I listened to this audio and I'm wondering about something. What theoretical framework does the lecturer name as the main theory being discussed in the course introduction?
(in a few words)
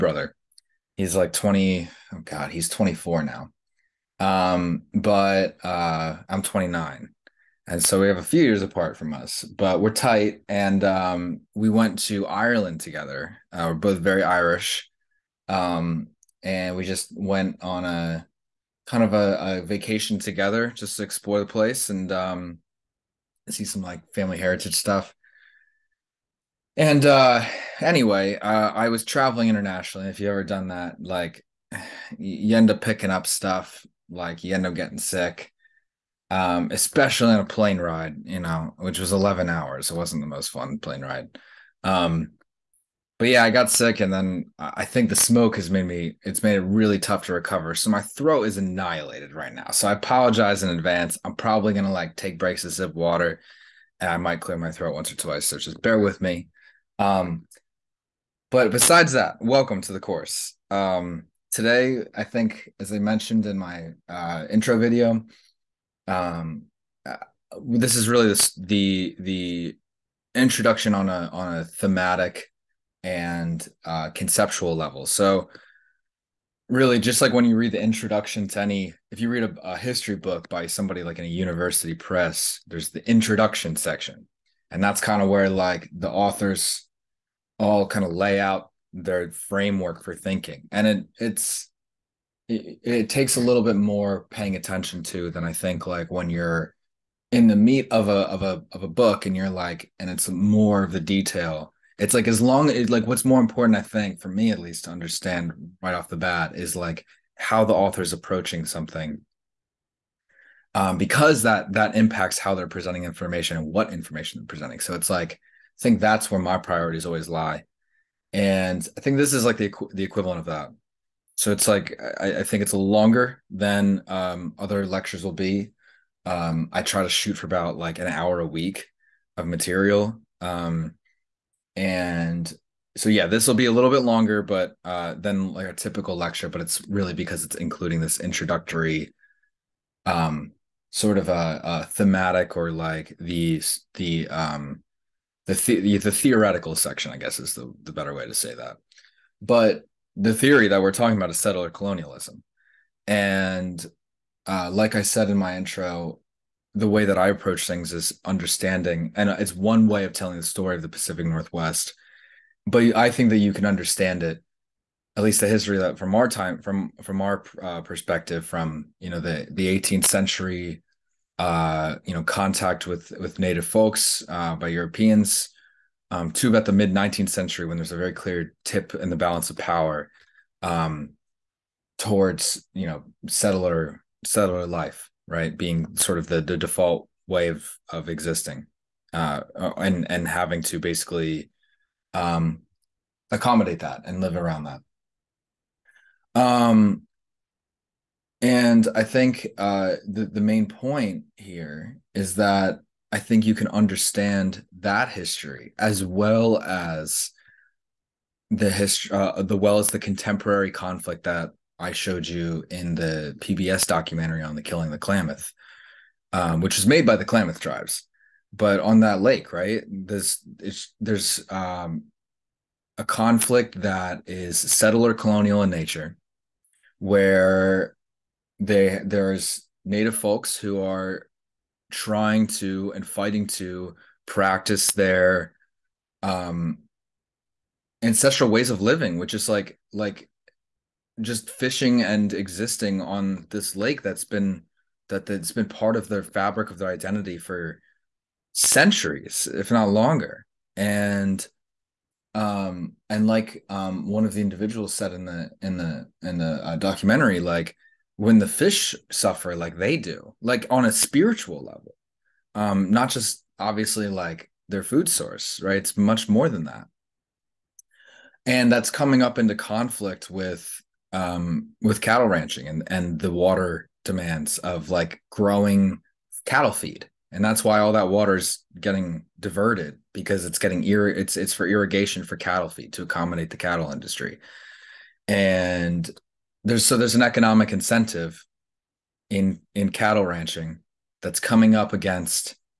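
Settler colonialism.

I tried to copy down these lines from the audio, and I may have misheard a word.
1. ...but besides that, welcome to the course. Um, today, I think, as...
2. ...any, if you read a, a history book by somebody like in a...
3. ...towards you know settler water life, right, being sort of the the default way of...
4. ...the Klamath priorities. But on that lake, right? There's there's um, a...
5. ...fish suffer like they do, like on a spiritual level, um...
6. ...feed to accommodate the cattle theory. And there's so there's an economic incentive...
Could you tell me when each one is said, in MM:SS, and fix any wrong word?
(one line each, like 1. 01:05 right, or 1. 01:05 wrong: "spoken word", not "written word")
1. 00:58 right
2. 01:18 right
3. 03:01 wrong: "settler", not "water"
4. 03:37 wrong: "tribes", not "priorities"
5. 04:18 right
6. 04:42 wrong: "industry", not "theory".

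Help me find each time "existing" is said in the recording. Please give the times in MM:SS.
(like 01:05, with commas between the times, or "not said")
03:08, 04:02.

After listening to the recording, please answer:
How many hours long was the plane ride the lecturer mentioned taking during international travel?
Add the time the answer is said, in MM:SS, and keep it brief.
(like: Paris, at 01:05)
11, at 00:39.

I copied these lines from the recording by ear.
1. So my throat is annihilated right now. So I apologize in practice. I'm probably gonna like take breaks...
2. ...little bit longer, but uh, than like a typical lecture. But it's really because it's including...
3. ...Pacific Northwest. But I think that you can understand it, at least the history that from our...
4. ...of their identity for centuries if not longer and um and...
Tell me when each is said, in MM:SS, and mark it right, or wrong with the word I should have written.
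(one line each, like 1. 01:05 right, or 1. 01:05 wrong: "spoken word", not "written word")
1. 00:47 wrong: "advance", not "practice"
2. 02:13 right
3. 02:40 right
4. 04:06 right.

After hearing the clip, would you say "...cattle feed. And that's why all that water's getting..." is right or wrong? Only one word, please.
right.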